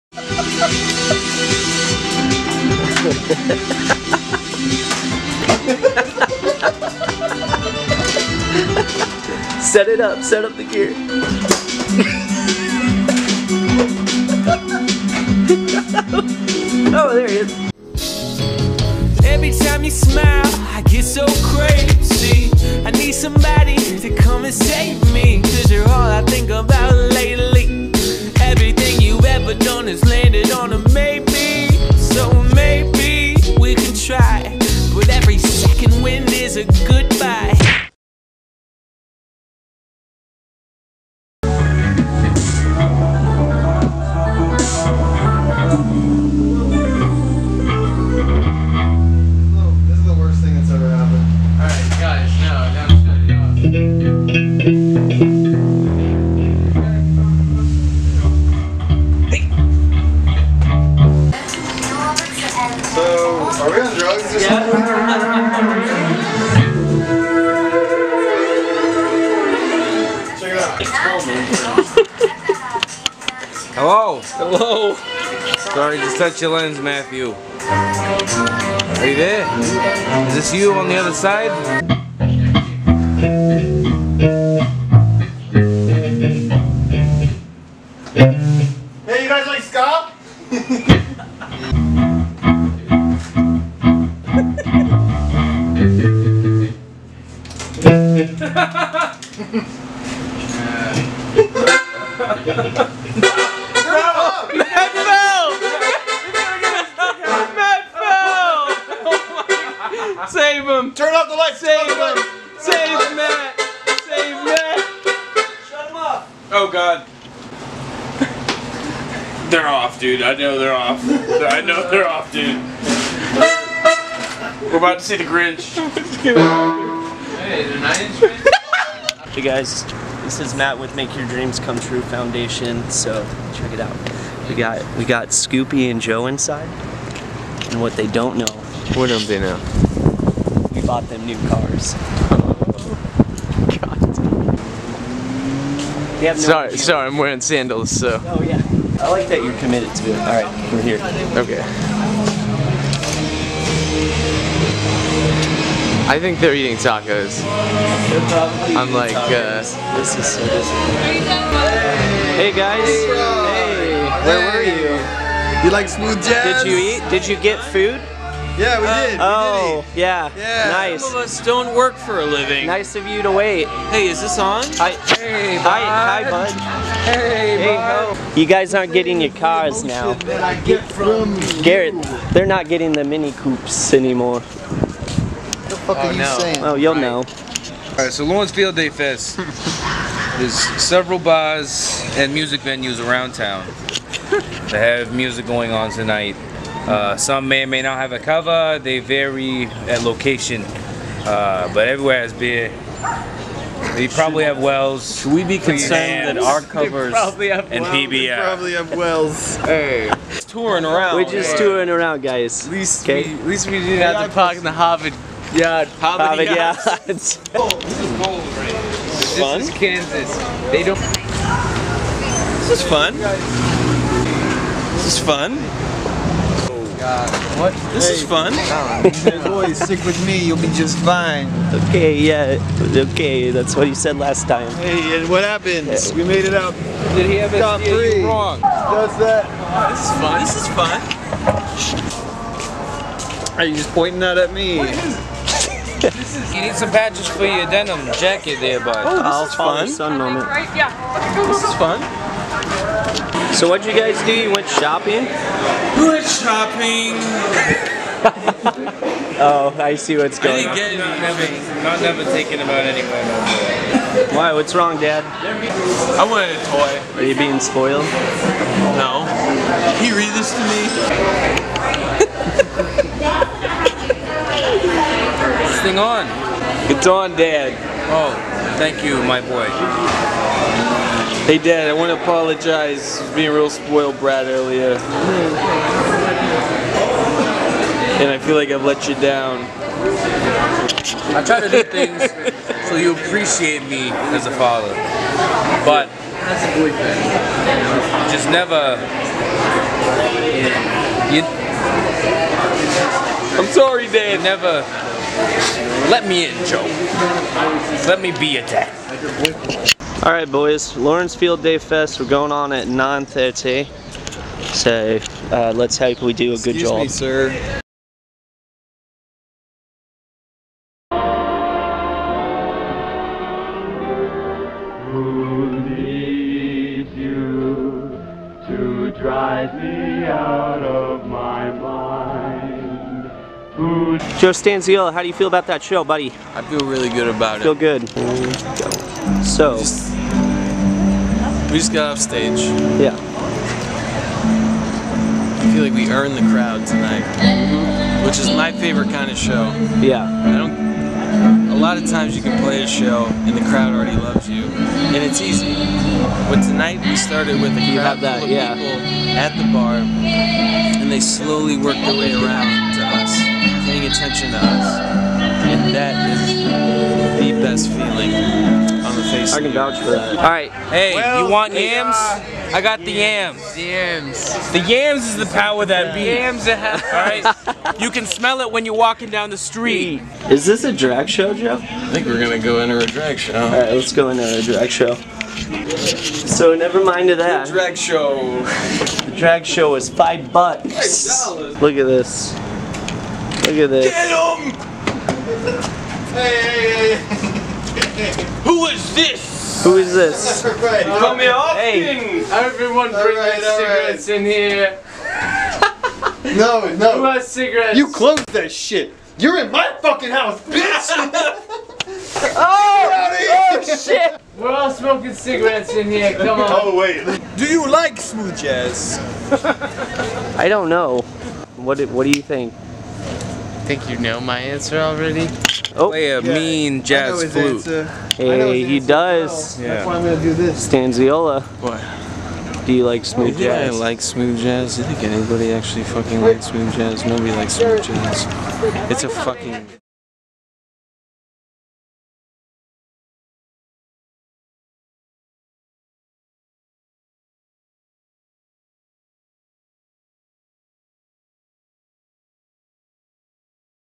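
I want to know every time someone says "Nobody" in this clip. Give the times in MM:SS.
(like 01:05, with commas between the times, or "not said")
07:17.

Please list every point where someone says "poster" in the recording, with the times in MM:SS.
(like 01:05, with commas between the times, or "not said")
not said.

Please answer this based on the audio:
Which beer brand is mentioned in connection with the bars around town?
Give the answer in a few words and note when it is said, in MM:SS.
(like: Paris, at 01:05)
PBR, at 03:27.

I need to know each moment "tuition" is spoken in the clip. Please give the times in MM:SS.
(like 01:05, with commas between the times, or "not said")
not said.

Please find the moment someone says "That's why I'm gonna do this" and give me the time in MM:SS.
07:09.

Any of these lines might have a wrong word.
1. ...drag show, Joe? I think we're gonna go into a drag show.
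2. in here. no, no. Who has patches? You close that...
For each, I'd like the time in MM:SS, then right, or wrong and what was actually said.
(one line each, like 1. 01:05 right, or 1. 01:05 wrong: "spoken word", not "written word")
1. 06:20 right
2. 06:44 wrong: "cigarettes", not "patches".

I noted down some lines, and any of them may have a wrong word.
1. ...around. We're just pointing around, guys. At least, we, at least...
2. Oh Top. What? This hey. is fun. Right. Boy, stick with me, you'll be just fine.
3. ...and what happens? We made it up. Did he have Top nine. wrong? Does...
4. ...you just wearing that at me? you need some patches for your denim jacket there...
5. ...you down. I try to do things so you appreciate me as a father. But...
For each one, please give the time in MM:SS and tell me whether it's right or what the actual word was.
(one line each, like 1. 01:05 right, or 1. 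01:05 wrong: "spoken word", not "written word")
1. 03:30 wrong: "touring", not "pointing"
2. 03:46 wrong: "God", not "Top"
3. 03:55 wrong: "three", not "nine"
4. 04:03 wrong: "pointing", not "wearing"
5. 04:49 right.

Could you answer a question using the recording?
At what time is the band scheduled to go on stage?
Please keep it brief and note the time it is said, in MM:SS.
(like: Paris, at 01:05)
9:30, at 05:12.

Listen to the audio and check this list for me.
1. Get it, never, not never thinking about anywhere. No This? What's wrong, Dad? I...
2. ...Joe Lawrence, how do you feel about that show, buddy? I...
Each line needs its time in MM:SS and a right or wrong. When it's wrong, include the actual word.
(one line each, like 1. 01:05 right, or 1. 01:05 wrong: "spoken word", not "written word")
1. 04:21 wrong: "Why", not "This"
2. 05:34 wrong: "Stanziella", not "Lawrence".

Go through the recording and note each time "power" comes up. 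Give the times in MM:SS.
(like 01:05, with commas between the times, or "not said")
06:15.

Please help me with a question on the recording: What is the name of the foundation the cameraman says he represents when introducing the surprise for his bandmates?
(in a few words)
Make Your Dreams Come True Foundation.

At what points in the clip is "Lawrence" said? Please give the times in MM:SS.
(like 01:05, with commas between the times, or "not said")
03:08, 05:10.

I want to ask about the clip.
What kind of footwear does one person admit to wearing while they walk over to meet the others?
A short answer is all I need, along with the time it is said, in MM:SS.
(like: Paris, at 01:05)
Sandals, at 02:27.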